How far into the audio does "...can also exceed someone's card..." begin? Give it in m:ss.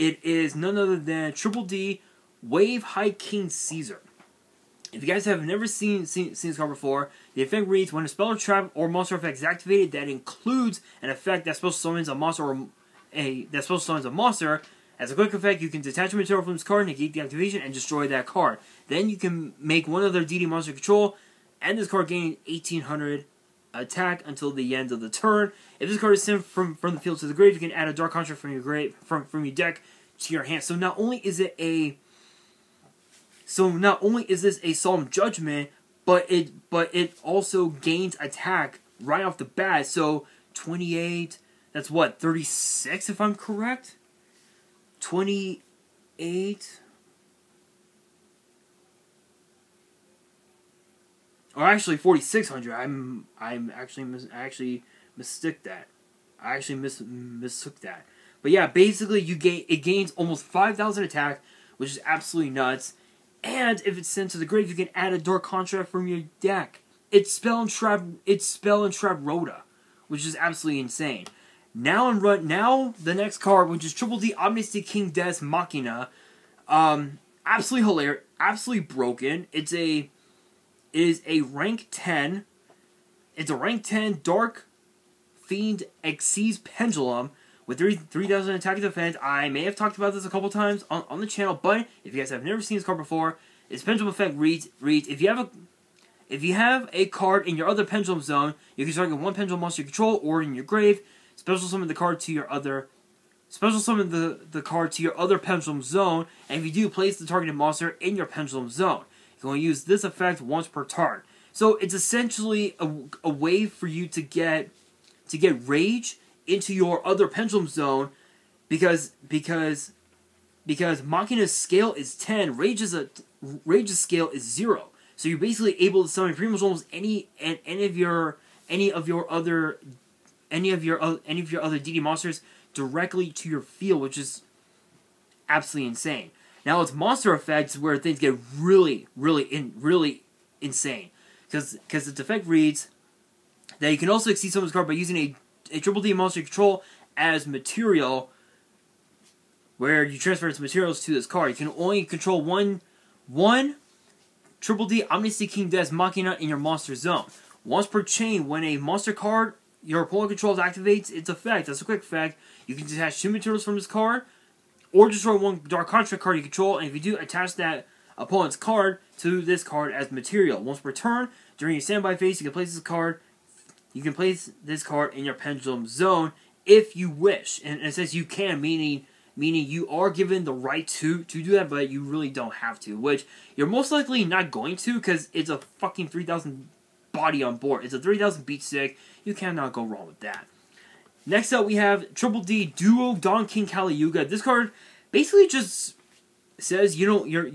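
2:23.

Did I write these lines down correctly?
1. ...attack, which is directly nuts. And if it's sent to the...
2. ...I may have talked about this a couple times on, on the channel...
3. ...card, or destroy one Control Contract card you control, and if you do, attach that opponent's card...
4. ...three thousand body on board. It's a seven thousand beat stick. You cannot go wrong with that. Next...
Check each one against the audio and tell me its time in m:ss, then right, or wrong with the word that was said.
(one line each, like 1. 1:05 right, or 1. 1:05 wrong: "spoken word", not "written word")
1. 1:01 wrong: "absolutely", not "directly"
2. 1:29 right
3. 2:43 wrong: "Dark", not "Control"
4. 3:06 wrong: "three", not "seven".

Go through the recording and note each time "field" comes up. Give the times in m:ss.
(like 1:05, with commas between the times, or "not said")
0:27, 2:13.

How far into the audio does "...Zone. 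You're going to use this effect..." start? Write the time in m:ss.
1:48.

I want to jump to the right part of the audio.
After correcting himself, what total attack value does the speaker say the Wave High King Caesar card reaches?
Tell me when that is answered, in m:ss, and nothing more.
0:51.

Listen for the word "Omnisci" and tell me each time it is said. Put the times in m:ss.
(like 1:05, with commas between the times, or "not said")
1:14, 2:35.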